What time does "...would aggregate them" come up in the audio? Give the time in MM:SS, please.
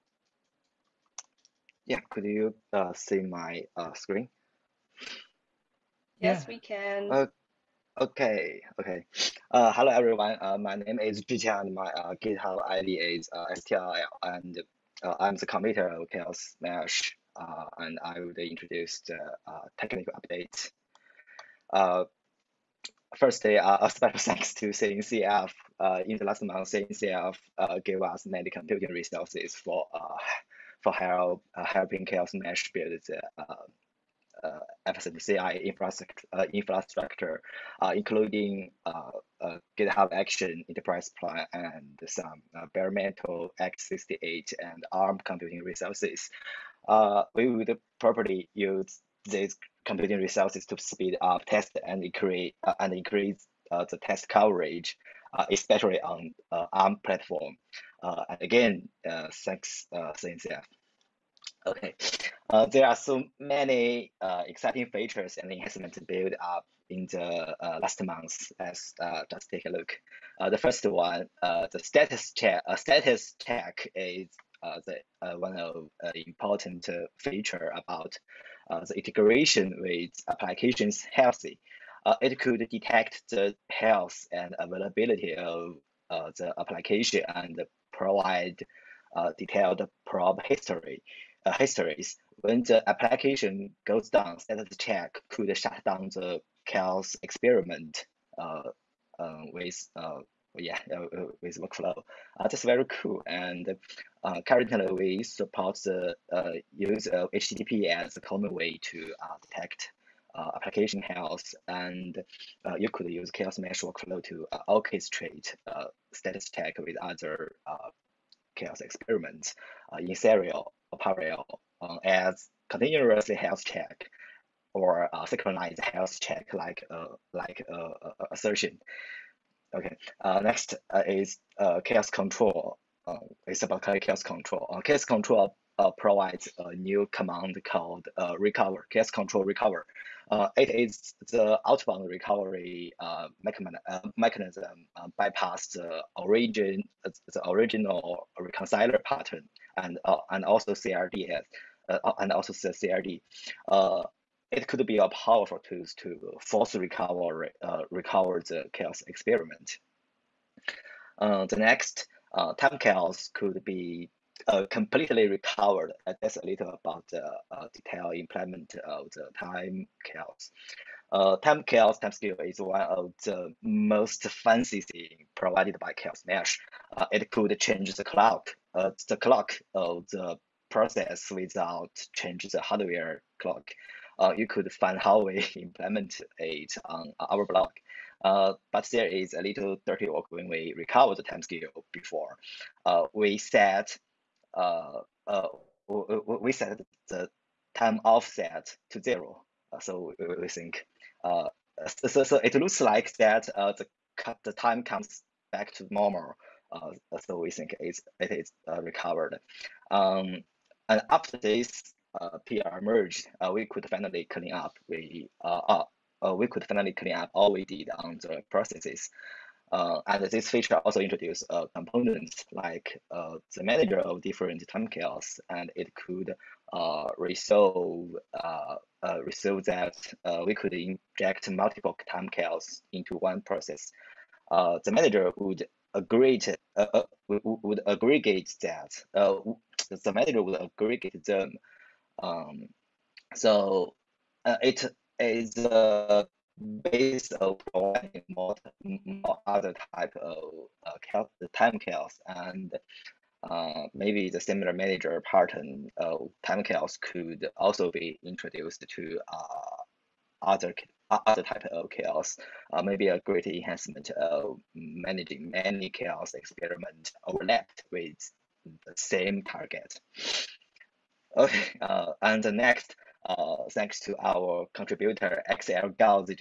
04:00.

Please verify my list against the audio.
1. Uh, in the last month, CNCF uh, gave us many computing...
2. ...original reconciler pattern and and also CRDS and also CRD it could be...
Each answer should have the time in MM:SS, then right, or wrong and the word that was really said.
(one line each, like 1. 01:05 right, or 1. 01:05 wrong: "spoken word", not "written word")
1. 00:25 right
2. 02:27 right.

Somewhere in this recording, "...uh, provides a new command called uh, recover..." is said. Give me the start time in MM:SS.
02:15.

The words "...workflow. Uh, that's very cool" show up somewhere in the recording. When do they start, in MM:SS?
01:41.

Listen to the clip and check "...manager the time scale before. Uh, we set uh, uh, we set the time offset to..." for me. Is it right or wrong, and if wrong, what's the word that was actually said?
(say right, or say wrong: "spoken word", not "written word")
wrong: "recover", not "manager".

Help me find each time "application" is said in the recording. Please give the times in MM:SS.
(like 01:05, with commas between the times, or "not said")
01:20, 01:26, 01:32, 01:50.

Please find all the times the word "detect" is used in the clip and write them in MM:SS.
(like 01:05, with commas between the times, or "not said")
01:22, 01:49.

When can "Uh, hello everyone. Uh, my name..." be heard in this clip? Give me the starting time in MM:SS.
00:09.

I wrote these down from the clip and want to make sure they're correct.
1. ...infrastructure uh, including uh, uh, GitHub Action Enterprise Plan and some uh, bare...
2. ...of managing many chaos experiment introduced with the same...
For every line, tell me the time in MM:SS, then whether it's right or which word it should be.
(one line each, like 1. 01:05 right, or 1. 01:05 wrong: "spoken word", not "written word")
1. 00:36 right
2. 04:24 wrong: "overlapped", not "introduced".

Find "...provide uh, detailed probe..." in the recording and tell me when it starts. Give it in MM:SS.
01:27.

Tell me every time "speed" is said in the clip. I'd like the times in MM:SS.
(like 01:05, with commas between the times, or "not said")
00:50.